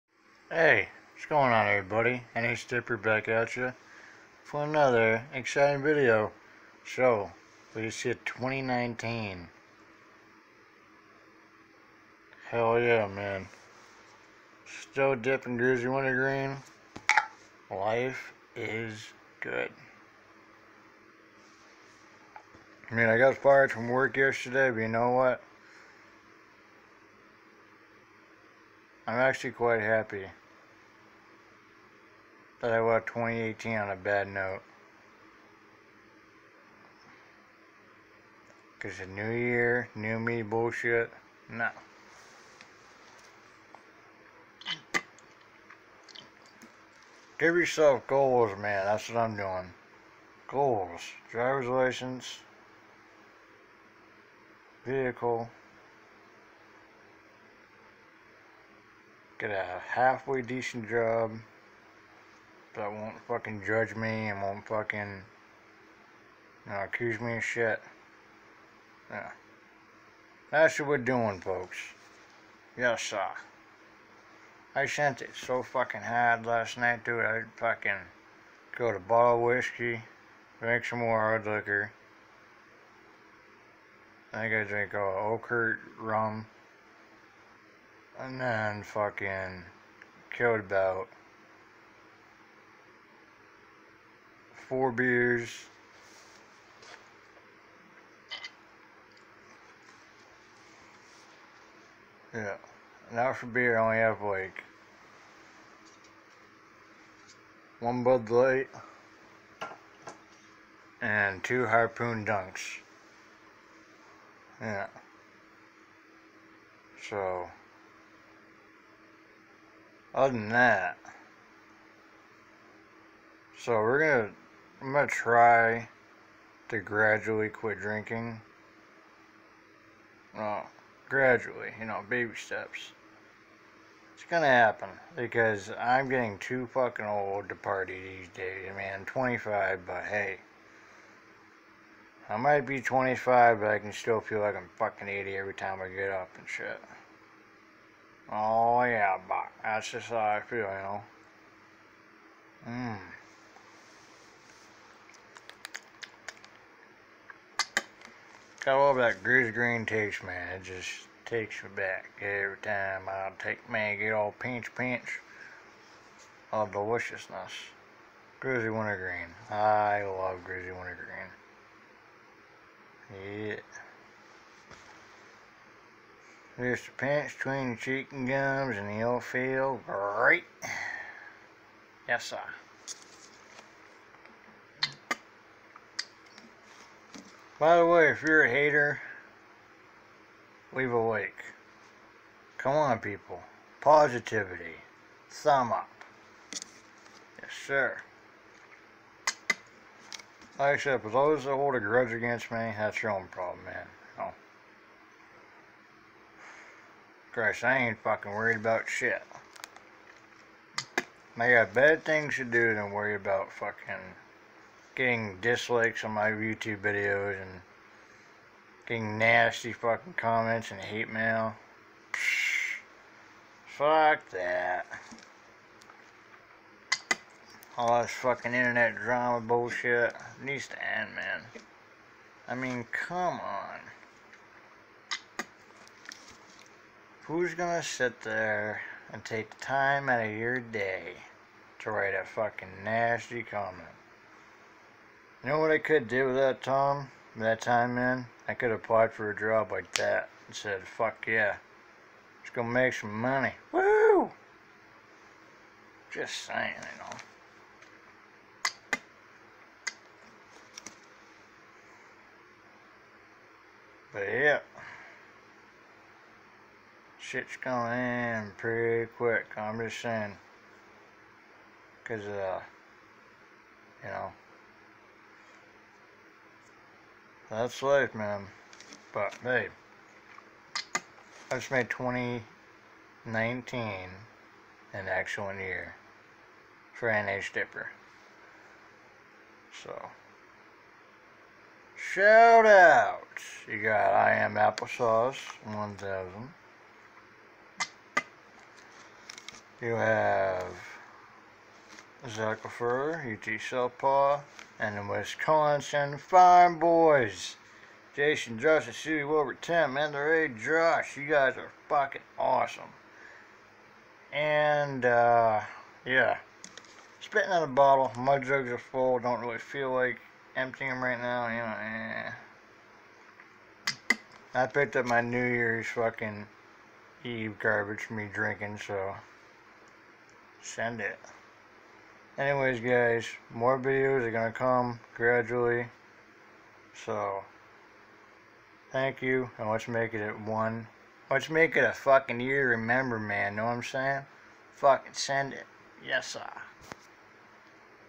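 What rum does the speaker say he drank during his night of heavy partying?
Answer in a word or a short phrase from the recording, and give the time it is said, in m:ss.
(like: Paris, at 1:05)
Okert rum, at 1:25.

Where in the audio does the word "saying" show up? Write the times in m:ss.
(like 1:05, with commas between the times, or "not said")
4:16, 4:30, 5:43.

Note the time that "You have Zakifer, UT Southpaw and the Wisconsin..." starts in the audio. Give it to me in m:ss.
4:59.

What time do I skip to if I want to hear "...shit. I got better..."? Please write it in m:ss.
3:28.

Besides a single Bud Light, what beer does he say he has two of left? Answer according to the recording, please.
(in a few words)
Harpoon Dunks.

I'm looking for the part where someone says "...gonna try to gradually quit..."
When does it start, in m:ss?
2:04.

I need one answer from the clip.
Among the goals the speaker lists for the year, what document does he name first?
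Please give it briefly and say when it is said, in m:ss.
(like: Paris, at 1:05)
Driver's license, at 0:51.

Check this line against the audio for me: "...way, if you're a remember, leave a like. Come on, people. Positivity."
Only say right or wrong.
wrong.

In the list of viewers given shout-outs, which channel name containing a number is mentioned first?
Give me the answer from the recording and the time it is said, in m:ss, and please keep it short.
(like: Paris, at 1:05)
I Am Applesauce 1000, at 4:54.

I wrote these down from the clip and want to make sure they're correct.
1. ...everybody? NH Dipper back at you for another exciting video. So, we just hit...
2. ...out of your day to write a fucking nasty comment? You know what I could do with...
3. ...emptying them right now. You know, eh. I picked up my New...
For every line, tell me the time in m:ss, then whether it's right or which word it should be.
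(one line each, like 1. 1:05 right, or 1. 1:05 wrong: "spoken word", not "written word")
1. 0:01 right
2. 4:00 right
3. 5:20 right.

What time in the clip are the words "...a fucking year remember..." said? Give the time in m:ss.
5:41.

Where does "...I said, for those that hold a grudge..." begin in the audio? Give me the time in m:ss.
3:20.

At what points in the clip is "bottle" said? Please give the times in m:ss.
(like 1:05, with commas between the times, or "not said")
1:18, 5:17.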